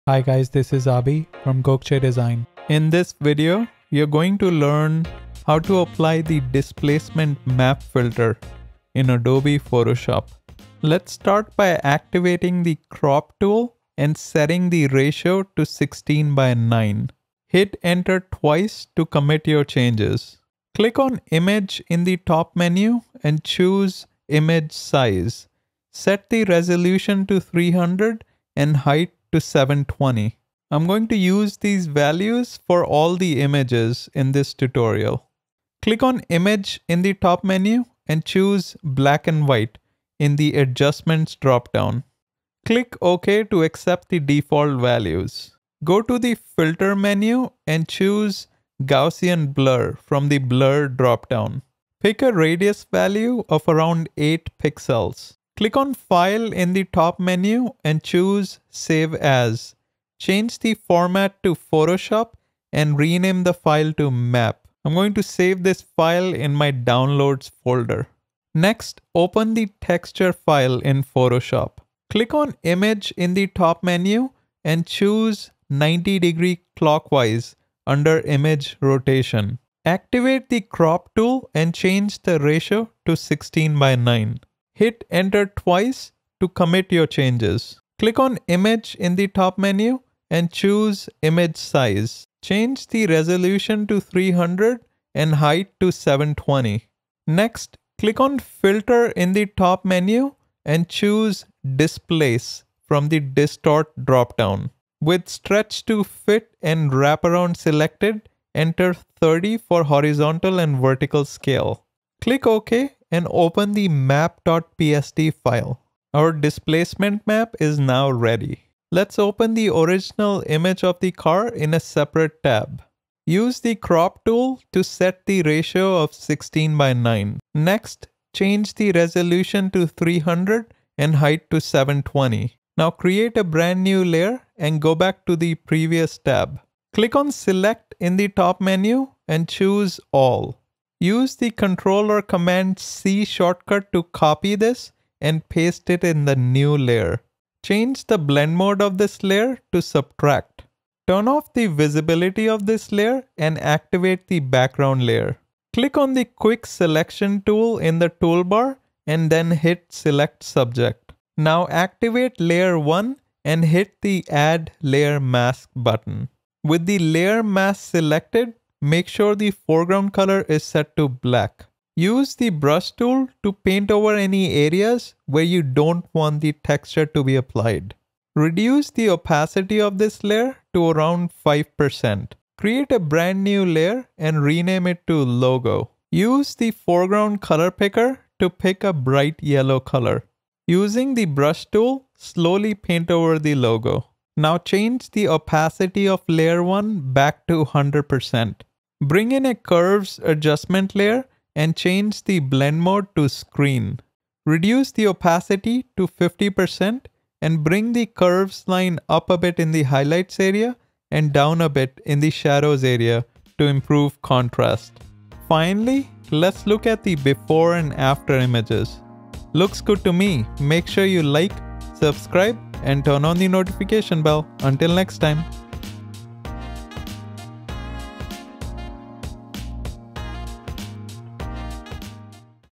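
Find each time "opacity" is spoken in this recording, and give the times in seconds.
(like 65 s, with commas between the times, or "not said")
179 s, 195 s, 205 s.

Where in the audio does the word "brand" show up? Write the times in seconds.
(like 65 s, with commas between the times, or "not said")
133 s, 182 s.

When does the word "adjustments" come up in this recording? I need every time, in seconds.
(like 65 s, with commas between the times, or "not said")
40 s, 200 s.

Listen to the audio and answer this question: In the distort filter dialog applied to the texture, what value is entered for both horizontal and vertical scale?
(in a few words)
30.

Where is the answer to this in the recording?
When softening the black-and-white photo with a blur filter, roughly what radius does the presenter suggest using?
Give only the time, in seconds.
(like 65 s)
54 s.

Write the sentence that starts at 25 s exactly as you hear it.
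Set the resolution to 300 and height to 720.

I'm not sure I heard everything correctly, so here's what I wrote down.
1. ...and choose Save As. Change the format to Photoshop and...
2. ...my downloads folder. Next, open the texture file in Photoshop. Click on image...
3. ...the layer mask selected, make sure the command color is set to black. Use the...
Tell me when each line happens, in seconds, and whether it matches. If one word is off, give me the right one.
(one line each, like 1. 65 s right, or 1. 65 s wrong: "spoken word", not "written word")
1. 57 s right
2. 66 s right
3. 166 s wrong: "foreground", not "command".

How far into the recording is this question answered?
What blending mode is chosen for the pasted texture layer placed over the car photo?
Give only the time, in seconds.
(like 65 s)
149 s.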